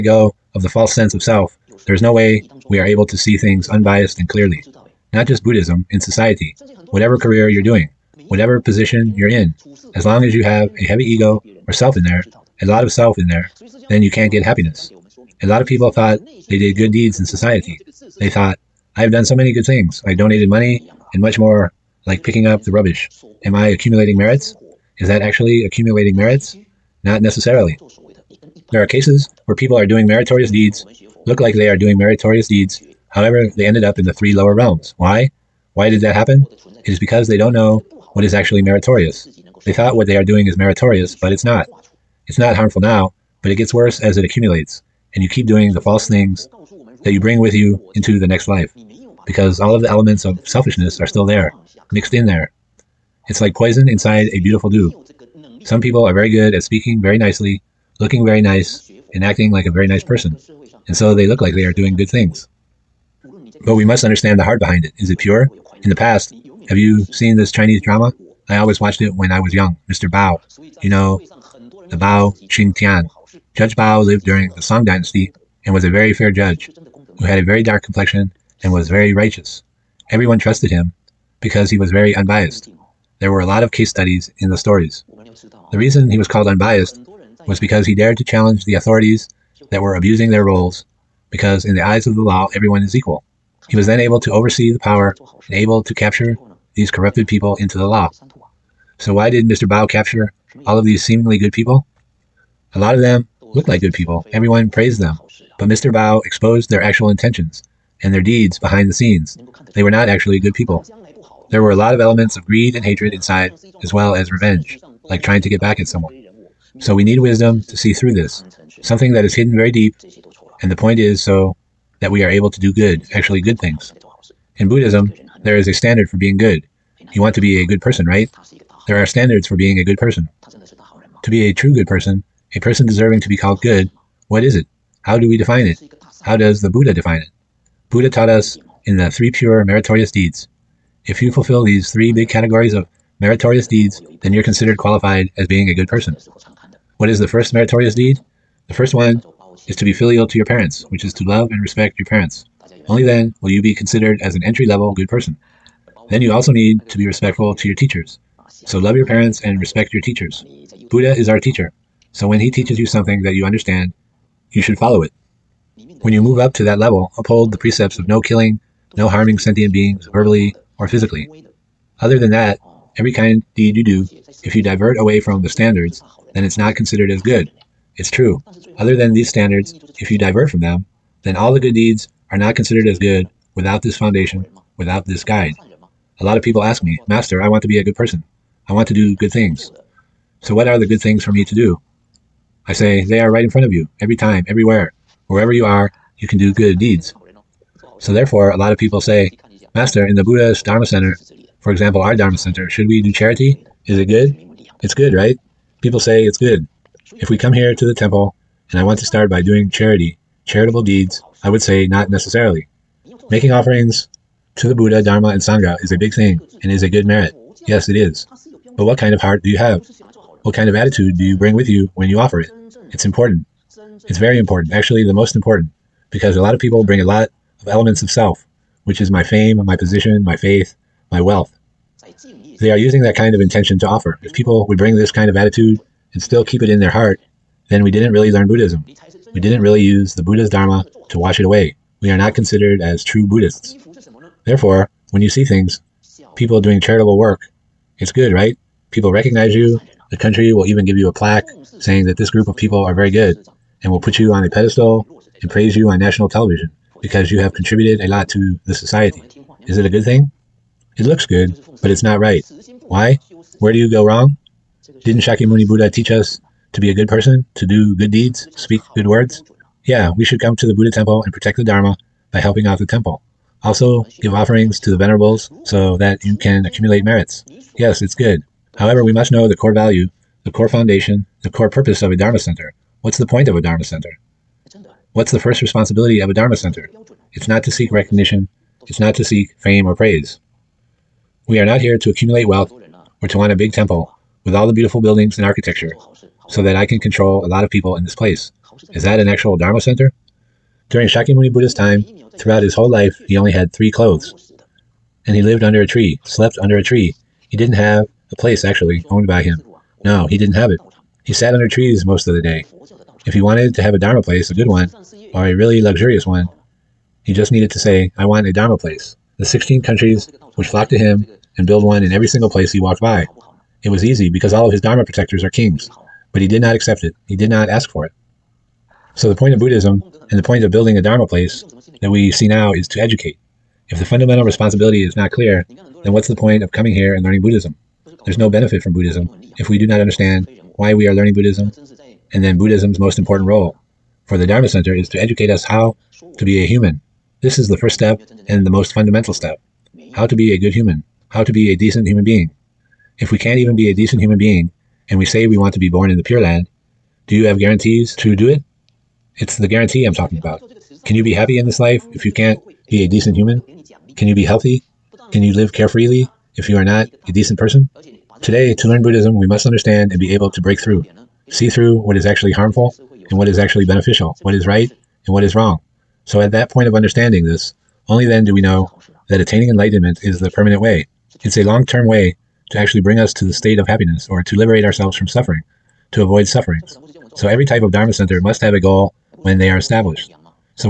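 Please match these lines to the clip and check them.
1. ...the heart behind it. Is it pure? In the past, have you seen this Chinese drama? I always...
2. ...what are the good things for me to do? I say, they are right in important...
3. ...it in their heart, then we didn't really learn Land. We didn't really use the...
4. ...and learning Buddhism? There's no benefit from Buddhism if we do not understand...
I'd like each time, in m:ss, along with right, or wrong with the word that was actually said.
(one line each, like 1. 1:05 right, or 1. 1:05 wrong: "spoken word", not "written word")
1. 1:04 right
2. 3:10 wrong: "front", not "important"
3. 3:56 wrong: "Buddhism", not "Land"
4. 5:37 right.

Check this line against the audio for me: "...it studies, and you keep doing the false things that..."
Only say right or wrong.
wrong.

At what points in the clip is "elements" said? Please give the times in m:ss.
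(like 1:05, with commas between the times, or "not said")
0:49, 1:51, 3:47.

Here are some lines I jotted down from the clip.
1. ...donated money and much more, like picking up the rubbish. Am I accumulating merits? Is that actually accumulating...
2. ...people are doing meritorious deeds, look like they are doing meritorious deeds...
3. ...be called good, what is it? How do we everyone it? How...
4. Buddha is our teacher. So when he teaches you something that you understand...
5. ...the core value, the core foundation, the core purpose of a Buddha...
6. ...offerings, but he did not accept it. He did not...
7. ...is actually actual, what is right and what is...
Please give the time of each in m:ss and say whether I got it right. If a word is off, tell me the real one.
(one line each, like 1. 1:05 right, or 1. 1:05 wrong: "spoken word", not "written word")
1. 0:20 right
2. 0:29 right
3. 2:13 wrong: "define", not "everyone"
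4. 2:40 right
5. 4:39 wrong: "Dharma", not "Buddha"
6. 5:25 wrong: "kings", not "offerings"
7. 6:13 wrong: "beneficial", not "actual".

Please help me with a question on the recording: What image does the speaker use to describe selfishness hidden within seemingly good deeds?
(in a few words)
Poison inside a beautiful dew.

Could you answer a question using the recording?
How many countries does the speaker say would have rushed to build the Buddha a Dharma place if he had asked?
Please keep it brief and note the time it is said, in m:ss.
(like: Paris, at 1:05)
16, at 5:19.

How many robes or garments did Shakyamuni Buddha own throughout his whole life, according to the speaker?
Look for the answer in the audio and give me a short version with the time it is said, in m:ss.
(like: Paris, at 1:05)
3, at 5:03.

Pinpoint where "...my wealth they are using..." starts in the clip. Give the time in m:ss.
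3:51.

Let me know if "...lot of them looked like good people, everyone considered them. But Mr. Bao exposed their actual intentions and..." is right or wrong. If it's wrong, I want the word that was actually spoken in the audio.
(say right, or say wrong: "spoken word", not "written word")
wrong: "praised", not "considered".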